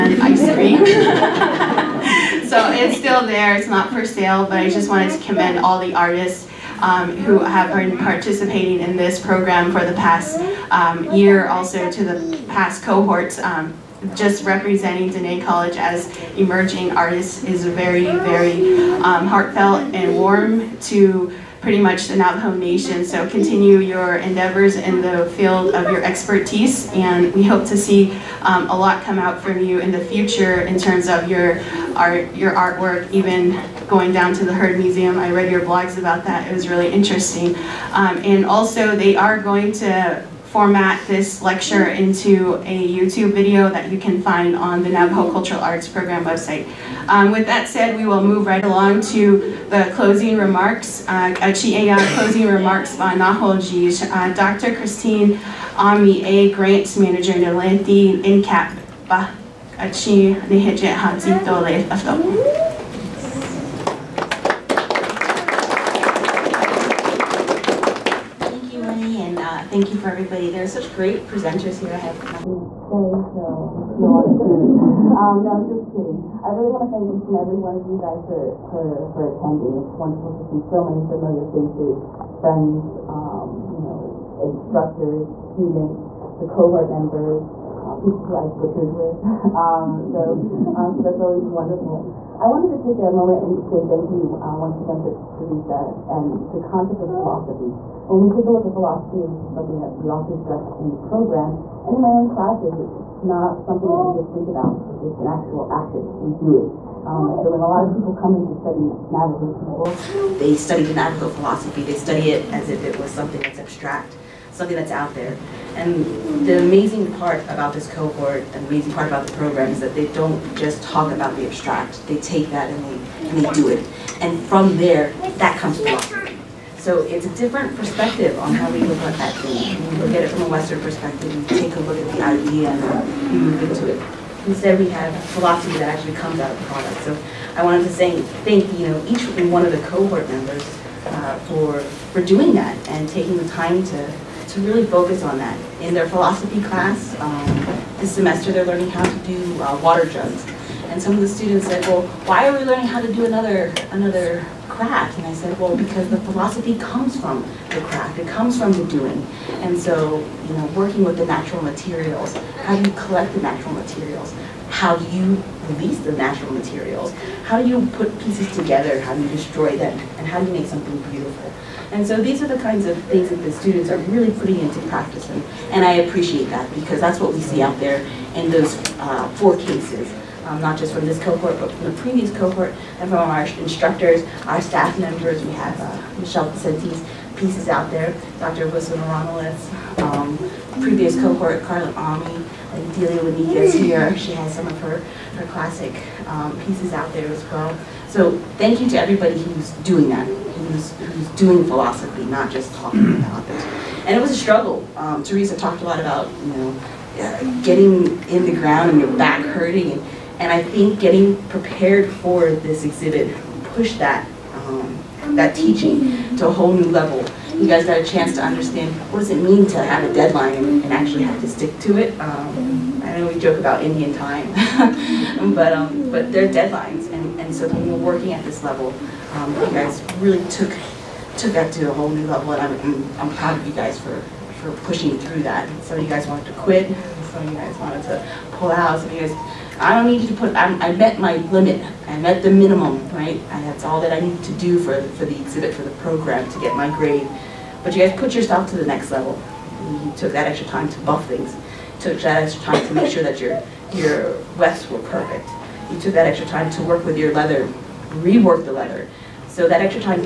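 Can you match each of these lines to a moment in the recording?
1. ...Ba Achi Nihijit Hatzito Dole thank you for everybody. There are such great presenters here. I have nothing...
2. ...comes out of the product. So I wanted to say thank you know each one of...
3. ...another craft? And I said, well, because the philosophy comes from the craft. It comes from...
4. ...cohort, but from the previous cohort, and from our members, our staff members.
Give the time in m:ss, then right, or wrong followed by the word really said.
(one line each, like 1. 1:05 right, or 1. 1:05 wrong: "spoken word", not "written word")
1. 0:59 right
2. 2:16 right
3. 2:33 right
4. 3:01 wrong: "instructors", not "members".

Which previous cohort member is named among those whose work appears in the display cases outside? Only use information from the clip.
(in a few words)
Carla Ami.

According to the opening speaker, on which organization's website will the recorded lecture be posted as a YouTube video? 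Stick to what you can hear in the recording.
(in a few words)
Navajo Cultural Arts Program.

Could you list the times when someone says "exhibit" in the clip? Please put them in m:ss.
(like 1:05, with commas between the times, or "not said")
3:32, 4:05.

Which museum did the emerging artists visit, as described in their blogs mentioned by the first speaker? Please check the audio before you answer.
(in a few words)
Heard Museum.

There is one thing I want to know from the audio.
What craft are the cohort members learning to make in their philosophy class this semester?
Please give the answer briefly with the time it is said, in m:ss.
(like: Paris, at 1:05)
water jugs, at 2:29.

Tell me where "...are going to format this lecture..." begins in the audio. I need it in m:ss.
0:39.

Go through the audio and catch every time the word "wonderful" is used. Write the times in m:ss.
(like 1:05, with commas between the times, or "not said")
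1:19, 1:31.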